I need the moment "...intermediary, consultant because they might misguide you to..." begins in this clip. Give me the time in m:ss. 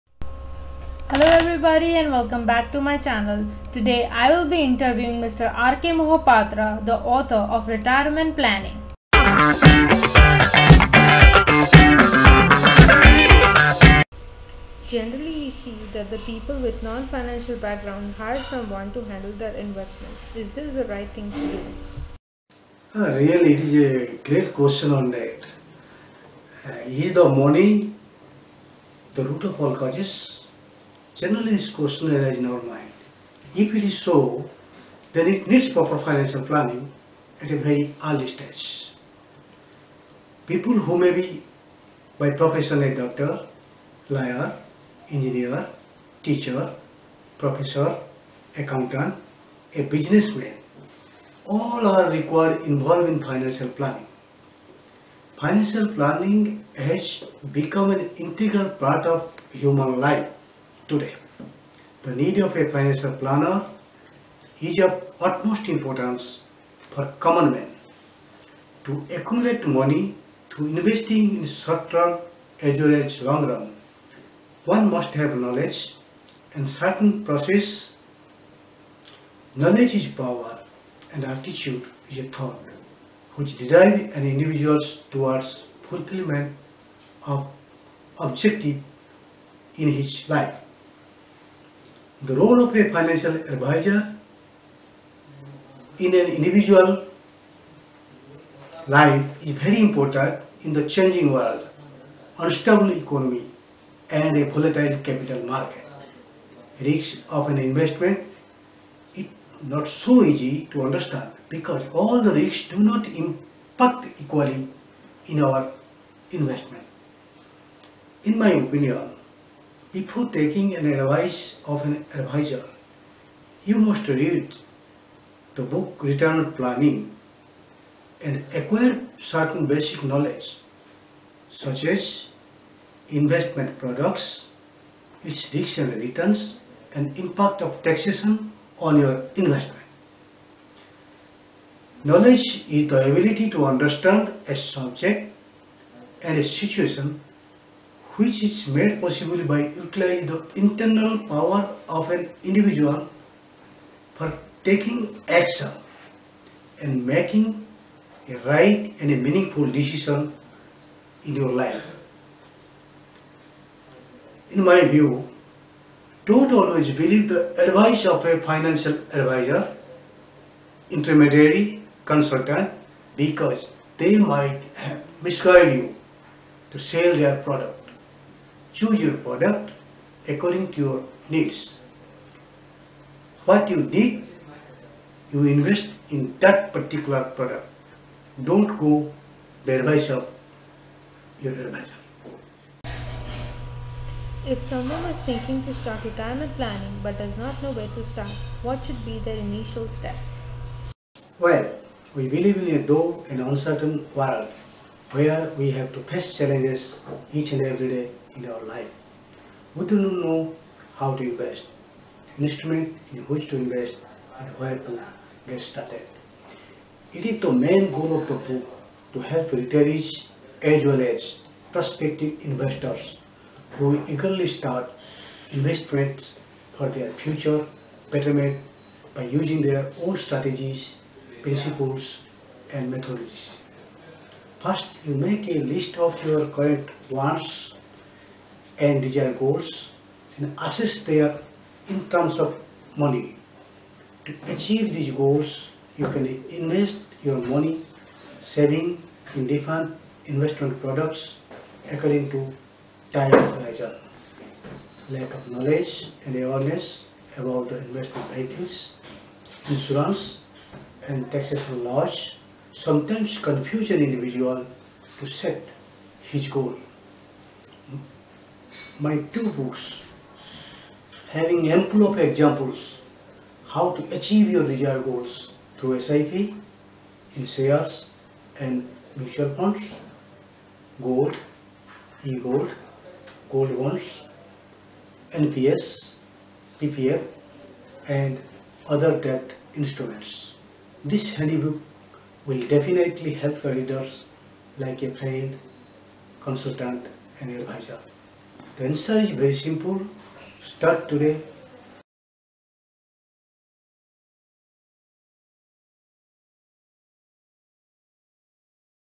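2:50.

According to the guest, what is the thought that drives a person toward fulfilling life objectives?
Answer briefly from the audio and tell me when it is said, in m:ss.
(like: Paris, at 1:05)
attitude, at 1:21.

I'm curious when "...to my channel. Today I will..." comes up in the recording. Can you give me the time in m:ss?
0:02.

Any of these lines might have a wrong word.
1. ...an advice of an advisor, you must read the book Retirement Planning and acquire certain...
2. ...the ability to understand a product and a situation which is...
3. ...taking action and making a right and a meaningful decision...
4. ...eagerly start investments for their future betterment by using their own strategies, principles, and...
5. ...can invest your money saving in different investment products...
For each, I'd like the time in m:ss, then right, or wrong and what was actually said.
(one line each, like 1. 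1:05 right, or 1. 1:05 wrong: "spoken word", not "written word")
1. 2:00 right
2. 2:22 wrong: "subject", not "product"
3. 2:34 right
4. 3:44 right
5. 4:06 right.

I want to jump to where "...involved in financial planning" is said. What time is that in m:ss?
0:52.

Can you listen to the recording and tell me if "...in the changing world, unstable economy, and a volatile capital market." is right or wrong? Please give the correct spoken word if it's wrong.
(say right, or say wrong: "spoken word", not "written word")
right.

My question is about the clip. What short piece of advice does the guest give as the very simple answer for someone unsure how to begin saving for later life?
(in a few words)
Start today.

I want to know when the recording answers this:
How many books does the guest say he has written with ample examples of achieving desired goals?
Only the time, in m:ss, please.
4:29.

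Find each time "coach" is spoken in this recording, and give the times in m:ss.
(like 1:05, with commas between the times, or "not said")
not said.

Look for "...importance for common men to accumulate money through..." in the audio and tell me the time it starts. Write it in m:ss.
1:05.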